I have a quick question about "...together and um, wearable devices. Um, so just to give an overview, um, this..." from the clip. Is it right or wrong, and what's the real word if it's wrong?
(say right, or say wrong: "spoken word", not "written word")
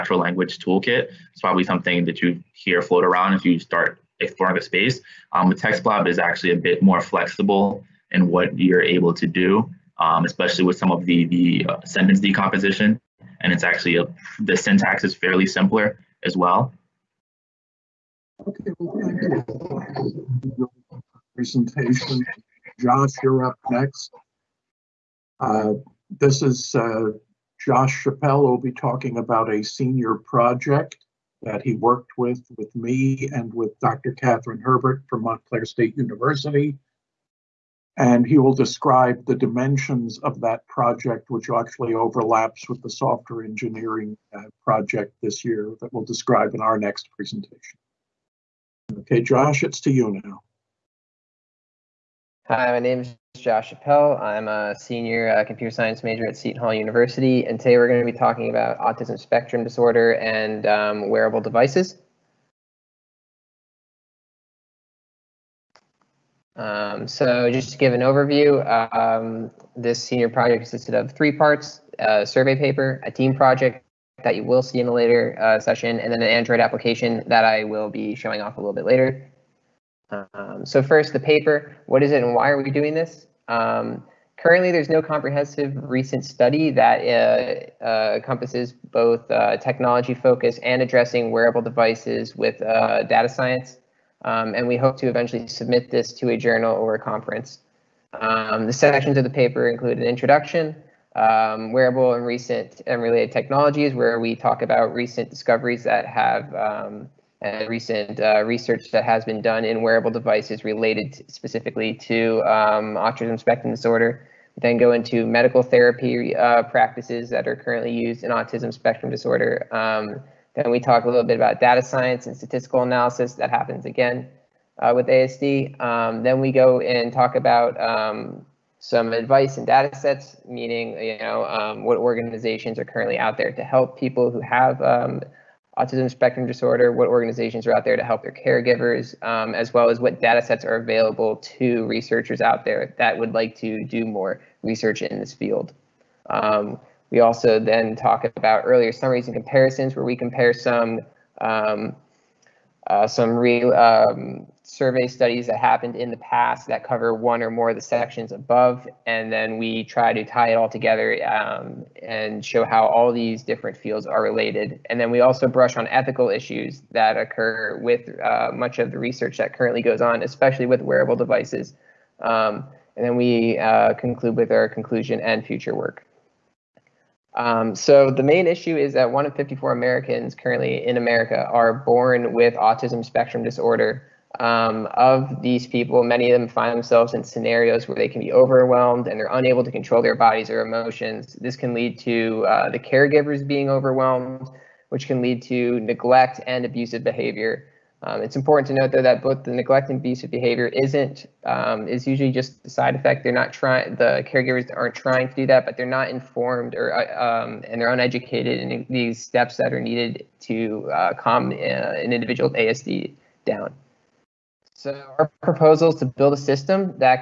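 wrong: "disorder", not "together".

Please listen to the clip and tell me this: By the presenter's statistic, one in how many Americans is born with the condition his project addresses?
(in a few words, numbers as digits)
54.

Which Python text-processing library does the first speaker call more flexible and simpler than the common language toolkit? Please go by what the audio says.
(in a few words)
TextBlob.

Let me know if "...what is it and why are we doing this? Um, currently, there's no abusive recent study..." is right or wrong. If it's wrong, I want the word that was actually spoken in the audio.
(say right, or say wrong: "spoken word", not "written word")
wrong: "comprehensive", not "abusive".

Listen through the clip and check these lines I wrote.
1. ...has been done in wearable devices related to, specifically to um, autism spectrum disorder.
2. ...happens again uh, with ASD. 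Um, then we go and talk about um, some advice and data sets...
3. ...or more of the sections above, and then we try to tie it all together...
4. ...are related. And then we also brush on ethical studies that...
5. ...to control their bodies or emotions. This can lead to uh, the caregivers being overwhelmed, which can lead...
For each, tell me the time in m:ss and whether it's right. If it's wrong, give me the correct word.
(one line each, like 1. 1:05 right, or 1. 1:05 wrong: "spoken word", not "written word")
1. 1:49 right
2. 2:03 right
3. 2:37 right
4. 2:44 wrong: "issues", not "studies"
5. 3:09 right.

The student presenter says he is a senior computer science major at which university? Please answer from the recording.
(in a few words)
Seton Hall University.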